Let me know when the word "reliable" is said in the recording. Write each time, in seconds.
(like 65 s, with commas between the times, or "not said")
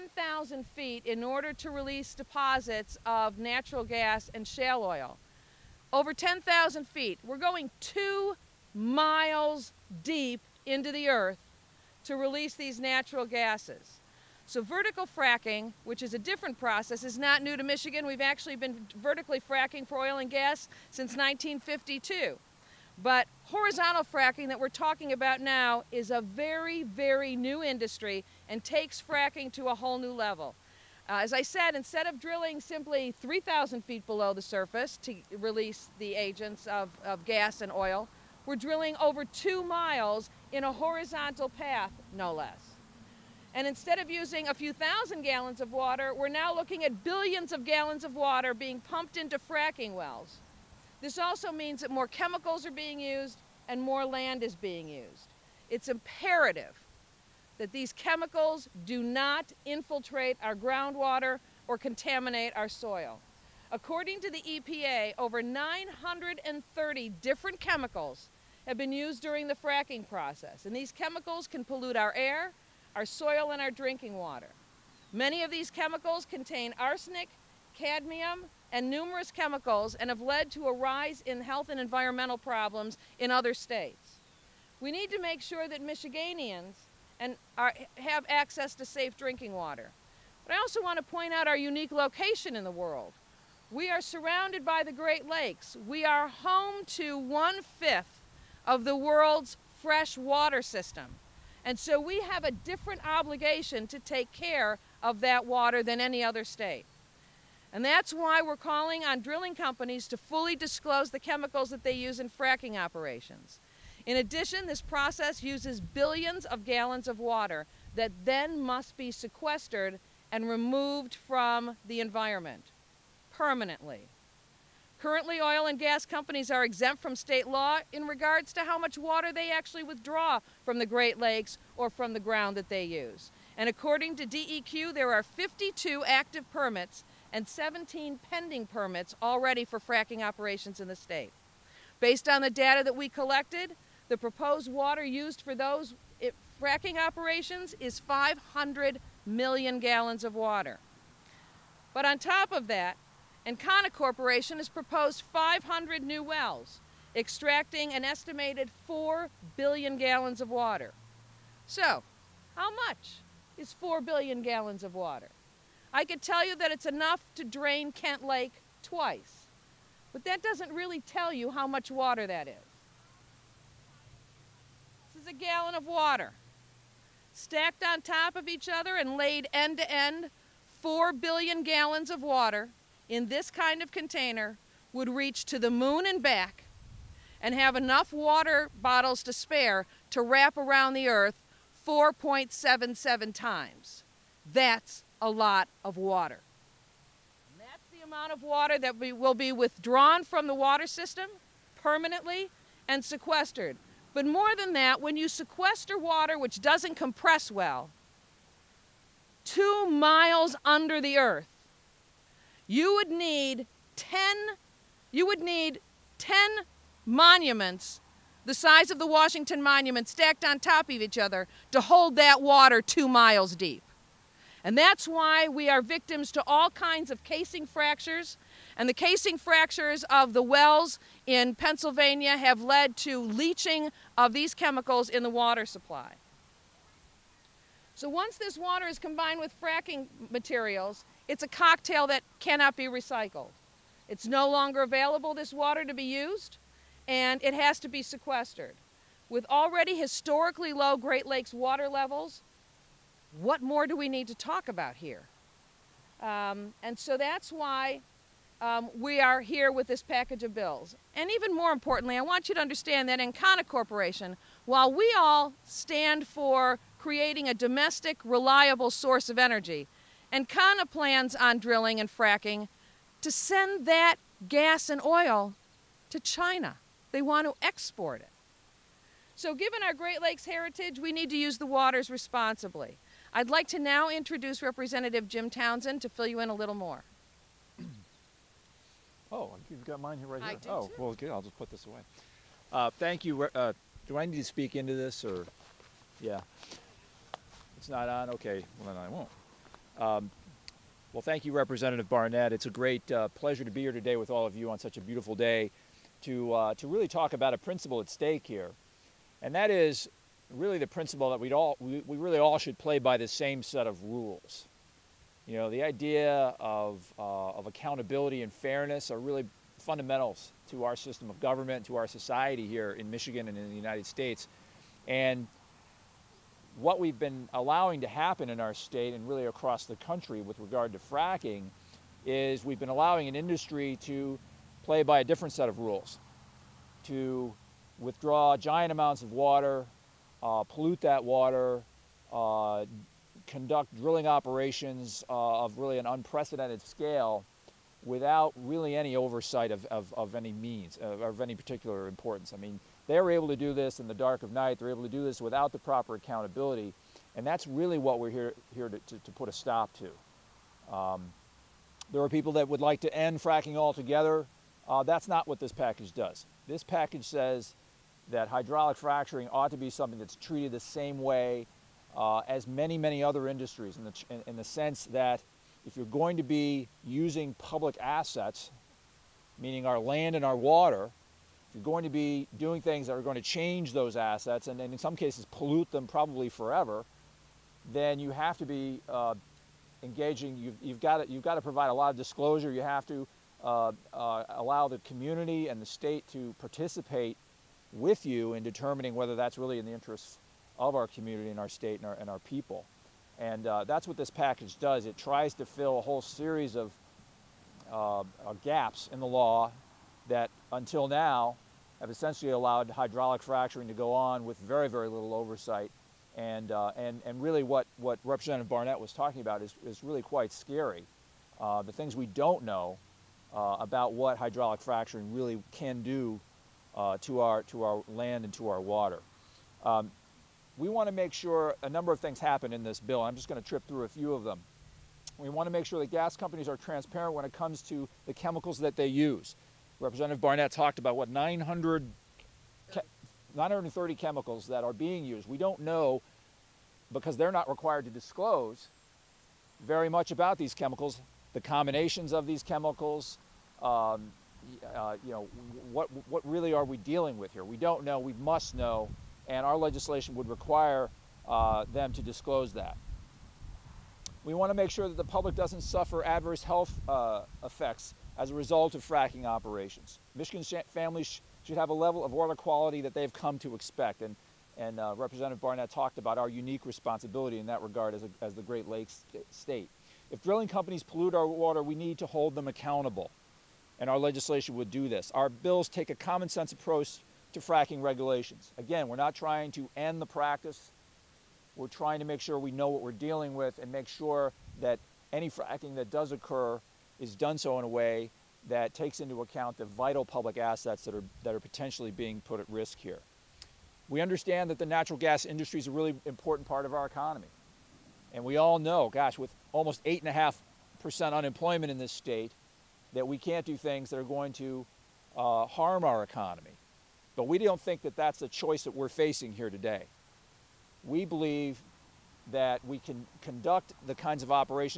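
268 s.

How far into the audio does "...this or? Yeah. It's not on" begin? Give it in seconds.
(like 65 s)
294 s.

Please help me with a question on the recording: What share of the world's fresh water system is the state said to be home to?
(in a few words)
One-fifth.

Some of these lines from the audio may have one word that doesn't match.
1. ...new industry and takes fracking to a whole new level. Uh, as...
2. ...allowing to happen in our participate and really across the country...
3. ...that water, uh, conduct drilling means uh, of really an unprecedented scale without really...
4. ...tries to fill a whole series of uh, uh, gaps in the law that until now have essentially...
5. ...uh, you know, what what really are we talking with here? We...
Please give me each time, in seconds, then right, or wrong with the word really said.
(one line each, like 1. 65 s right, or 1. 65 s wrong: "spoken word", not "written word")
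1. 27 s right
2. 327 s wrong: "state", not "participate"
3. 341 s wrong: "operations", not "means"
4. 405 s right
5. 454 s wrong: "dealing", not "talking".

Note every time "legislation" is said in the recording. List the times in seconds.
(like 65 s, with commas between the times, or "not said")
459 s, 484 s.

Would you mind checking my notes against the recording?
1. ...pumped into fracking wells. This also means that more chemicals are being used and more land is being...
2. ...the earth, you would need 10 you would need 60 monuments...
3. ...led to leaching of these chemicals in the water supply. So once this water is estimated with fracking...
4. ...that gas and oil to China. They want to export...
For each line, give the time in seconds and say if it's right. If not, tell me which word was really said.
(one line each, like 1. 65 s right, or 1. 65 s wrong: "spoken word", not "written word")
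1. 48 s right
2. 211 s wrong: "10", not "60"
3. 232 s wrong: "combined", not "estimated"
4. 273 s right.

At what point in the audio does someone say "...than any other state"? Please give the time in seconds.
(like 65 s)
105 s.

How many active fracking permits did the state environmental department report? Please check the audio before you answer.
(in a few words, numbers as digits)
52.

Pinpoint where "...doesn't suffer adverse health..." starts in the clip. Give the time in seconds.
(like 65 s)
465 s.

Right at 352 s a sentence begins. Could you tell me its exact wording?
I mean, they are able to do this in the dark of night.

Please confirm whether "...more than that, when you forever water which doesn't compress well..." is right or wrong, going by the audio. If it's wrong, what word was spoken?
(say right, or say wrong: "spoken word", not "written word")
wrong: "sequester", not "forever".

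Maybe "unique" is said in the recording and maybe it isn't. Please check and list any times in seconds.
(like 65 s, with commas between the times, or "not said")
91 s, 476 s.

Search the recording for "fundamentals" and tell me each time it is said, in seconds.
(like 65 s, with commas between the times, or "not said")
319 s.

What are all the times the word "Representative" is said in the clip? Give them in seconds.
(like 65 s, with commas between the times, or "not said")
284 s, 301 s, 418 s, 439 s, 475 s.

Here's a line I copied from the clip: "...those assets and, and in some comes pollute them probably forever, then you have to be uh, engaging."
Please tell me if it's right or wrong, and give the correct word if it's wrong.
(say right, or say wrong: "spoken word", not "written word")
wrong: "cases", not "comes".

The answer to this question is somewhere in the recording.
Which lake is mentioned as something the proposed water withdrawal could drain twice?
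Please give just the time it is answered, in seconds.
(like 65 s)
167 s.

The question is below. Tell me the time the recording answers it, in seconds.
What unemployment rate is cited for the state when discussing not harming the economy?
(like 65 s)
510 s.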